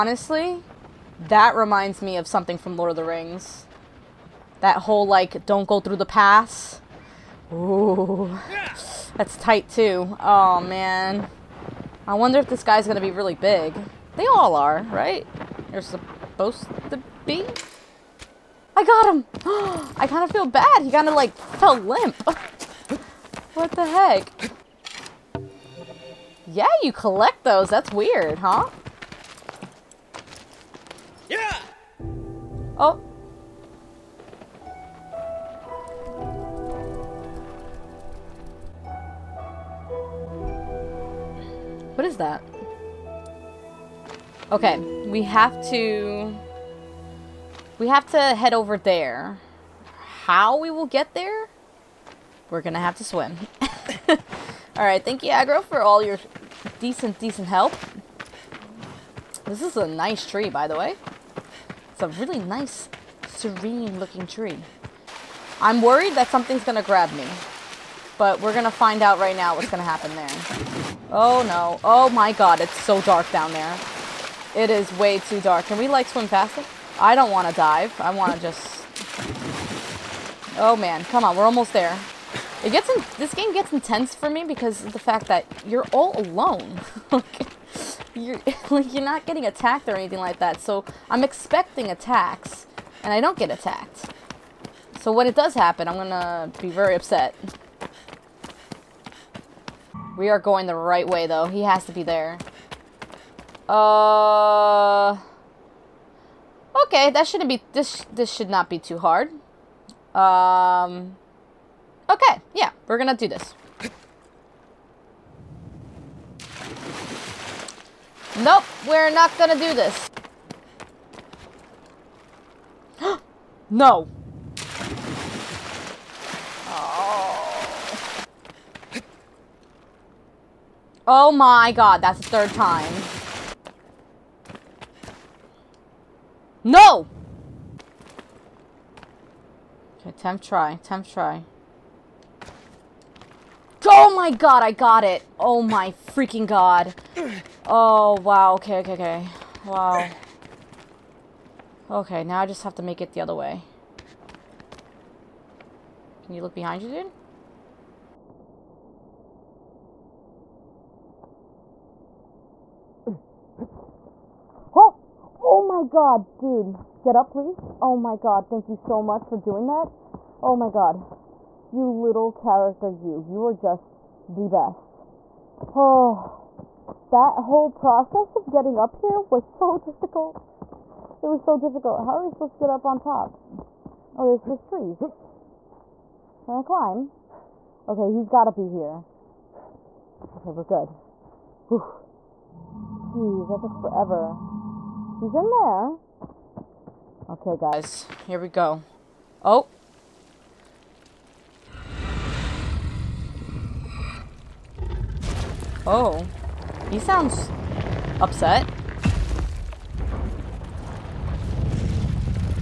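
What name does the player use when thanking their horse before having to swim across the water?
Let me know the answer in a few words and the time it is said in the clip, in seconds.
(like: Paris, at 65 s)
Agro, at 55 s.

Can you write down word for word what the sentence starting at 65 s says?
I'm worried that something's gonna grab me.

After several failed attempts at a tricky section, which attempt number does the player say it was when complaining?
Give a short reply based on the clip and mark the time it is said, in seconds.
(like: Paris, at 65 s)
3, at 132 s.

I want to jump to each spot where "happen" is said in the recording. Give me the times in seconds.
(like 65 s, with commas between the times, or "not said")
69 s, 95 s.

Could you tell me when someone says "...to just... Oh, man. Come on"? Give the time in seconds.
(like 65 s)
78 s.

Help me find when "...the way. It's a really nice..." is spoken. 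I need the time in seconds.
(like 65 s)
60 s.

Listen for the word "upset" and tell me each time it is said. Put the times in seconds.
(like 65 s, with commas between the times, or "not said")
96 s, 208 s.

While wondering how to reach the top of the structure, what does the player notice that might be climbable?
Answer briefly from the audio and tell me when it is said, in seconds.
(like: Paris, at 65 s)
trees, at 184 s.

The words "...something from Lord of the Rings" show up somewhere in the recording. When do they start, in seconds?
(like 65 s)
2 s.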